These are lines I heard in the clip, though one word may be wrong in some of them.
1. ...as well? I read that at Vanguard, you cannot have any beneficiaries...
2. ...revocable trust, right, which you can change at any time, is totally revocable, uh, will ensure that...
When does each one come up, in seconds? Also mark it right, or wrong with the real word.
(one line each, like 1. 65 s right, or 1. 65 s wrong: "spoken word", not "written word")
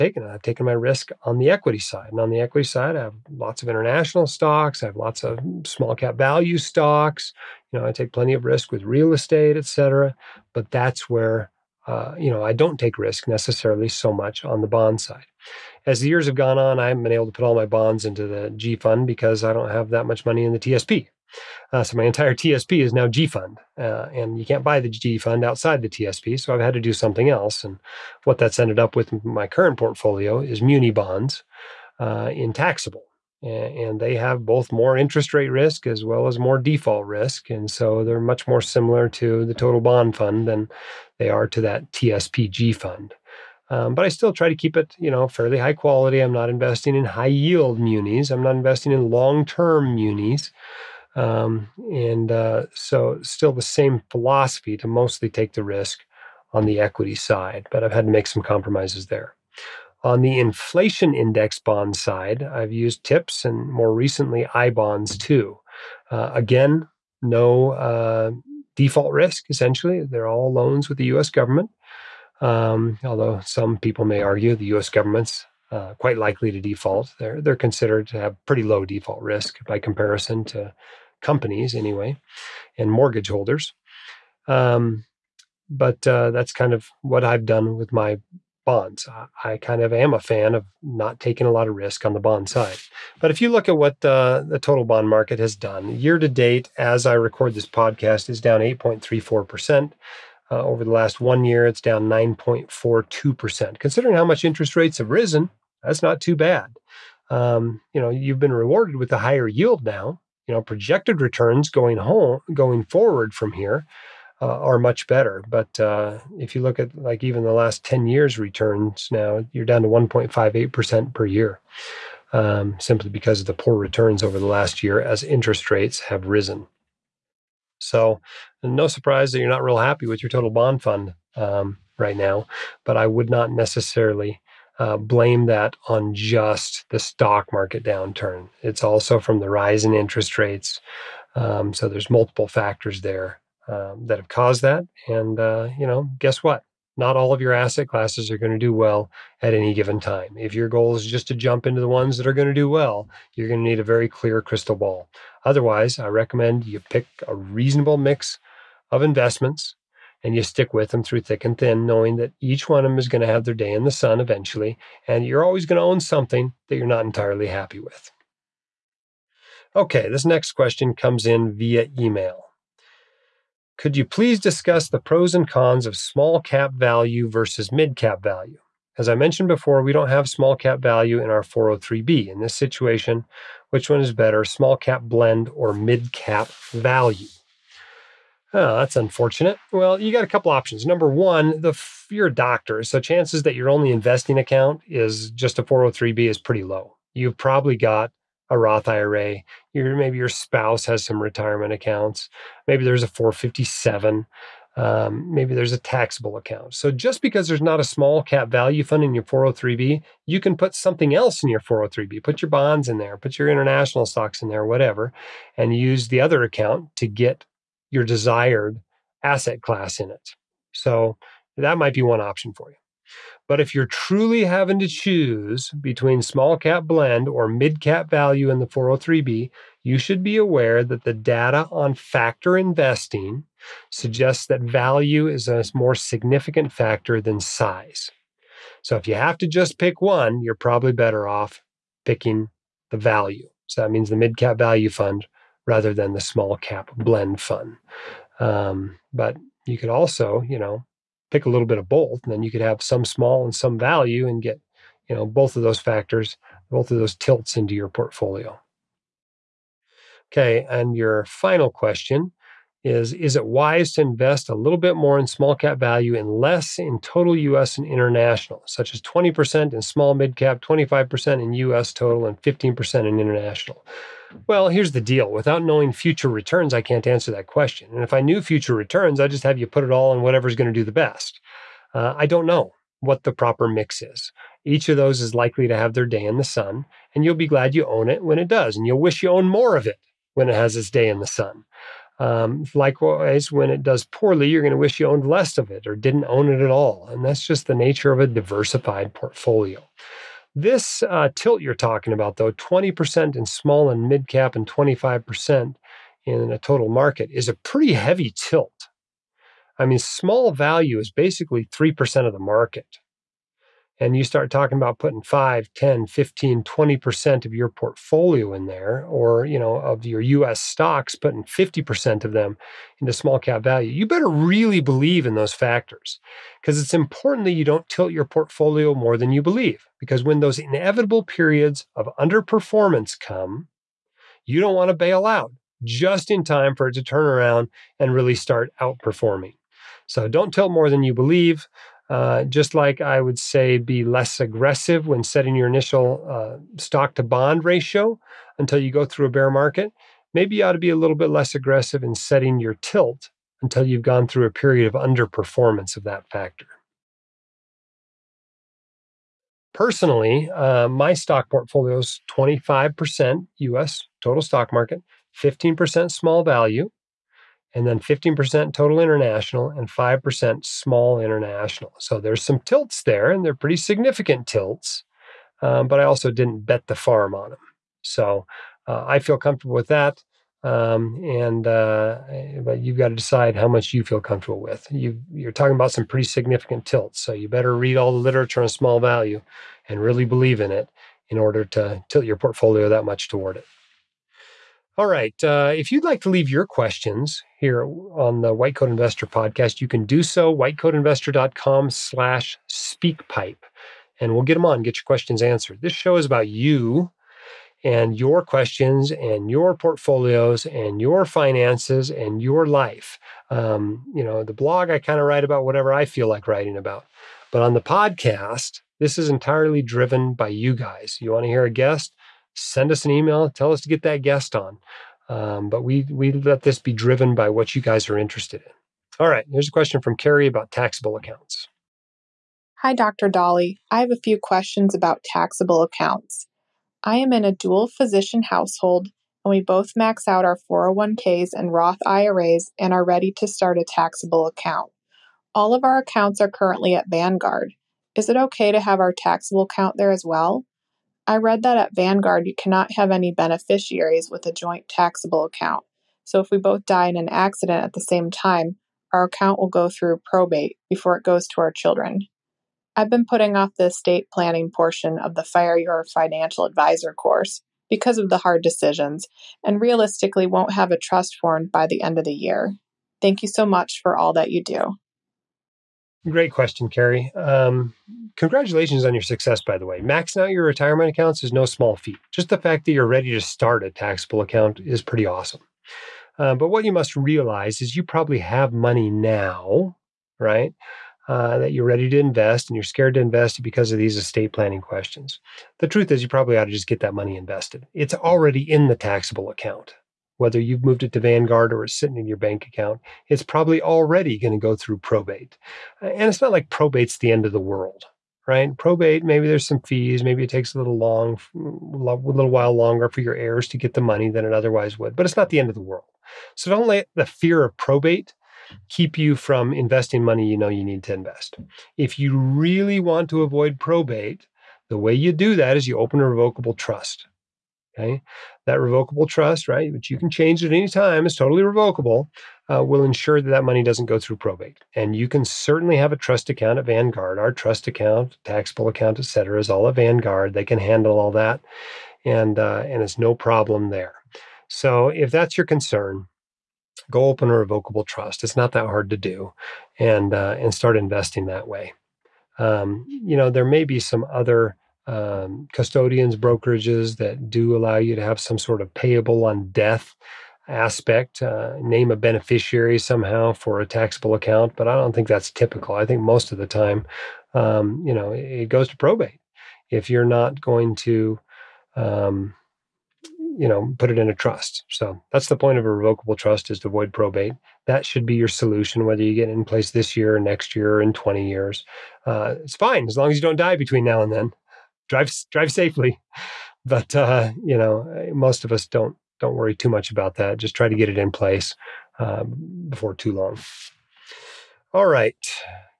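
1. 450 s right
2. 528 s right.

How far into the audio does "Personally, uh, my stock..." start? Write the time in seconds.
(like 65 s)
359 s.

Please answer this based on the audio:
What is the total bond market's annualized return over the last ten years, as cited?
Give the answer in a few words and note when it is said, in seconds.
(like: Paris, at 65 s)
1.58%, at 119 s.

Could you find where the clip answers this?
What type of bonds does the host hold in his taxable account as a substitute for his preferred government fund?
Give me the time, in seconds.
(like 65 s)
30 s.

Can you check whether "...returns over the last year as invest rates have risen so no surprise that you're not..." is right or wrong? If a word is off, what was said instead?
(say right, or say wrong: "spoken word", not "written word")
wrong: "interest", not "invest".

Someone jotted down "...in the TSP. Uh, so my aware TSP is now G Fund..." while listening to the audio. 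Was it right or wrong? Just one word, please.
wrong.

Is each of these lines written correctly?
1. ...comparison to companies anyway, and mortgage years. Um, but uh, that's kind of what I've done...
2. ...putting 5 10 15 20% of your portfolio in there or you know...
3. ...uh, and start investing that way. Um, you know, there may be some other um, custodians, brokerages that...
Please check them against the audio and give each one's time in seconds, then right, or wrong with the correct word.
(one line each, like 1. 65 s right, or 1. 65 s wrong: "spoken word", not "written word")
1. 79 s wrong: "holders", not "years"
2. 314 s right
3. 550 s right.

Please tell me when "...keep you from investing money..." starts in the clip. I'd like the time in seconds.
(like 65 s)
518 s.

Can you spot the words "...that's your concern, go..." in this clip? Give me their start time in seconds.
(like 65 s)
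545 s.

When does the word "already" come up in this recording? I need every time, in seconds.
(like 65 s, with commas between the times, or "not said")
498 s, 503 s.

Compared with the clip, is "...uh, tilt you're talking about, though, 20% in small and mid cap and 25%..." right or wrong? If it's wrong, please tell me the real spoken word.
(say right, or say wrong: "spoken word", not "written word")
right.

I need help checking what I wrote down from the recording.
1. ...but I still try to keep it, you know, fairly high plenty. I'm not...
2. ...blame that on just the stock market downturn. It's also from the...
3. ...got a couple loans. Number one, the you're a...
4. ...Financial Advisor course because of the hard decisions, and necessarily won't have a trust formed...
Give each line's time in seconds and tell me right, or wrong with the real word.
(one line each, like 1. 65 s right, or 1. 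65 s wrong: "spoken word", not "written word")
1. 43 s wrong: "quality", not "plenty"
2. 134 s right
3. 190 s wrong: "options", not "loans"
4. 466 s wrong: "realistically", not "necessarily".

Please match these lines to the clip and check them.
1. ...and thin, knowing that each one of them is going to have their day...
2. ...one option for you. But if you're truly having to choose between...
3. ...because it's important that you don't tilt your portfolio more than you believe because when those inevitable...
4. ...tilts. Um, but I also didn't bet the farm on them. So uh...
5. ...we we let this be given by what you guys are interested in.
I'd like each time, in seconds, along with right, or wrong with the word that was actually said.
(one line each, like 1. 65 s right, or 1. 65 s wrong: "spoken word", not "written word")
1. 161 s right
2. 222 s right
3. 326 s right
4. 374 s right
5. 425 s wrong: "driven", not "given".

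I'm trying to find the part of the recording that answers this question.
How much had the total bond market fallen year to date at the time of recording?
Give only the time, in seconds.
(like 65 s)
98 s.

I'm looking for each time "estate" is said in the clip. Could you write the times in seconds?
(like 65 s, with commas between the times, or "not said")
9 s, 463 s, 494 s.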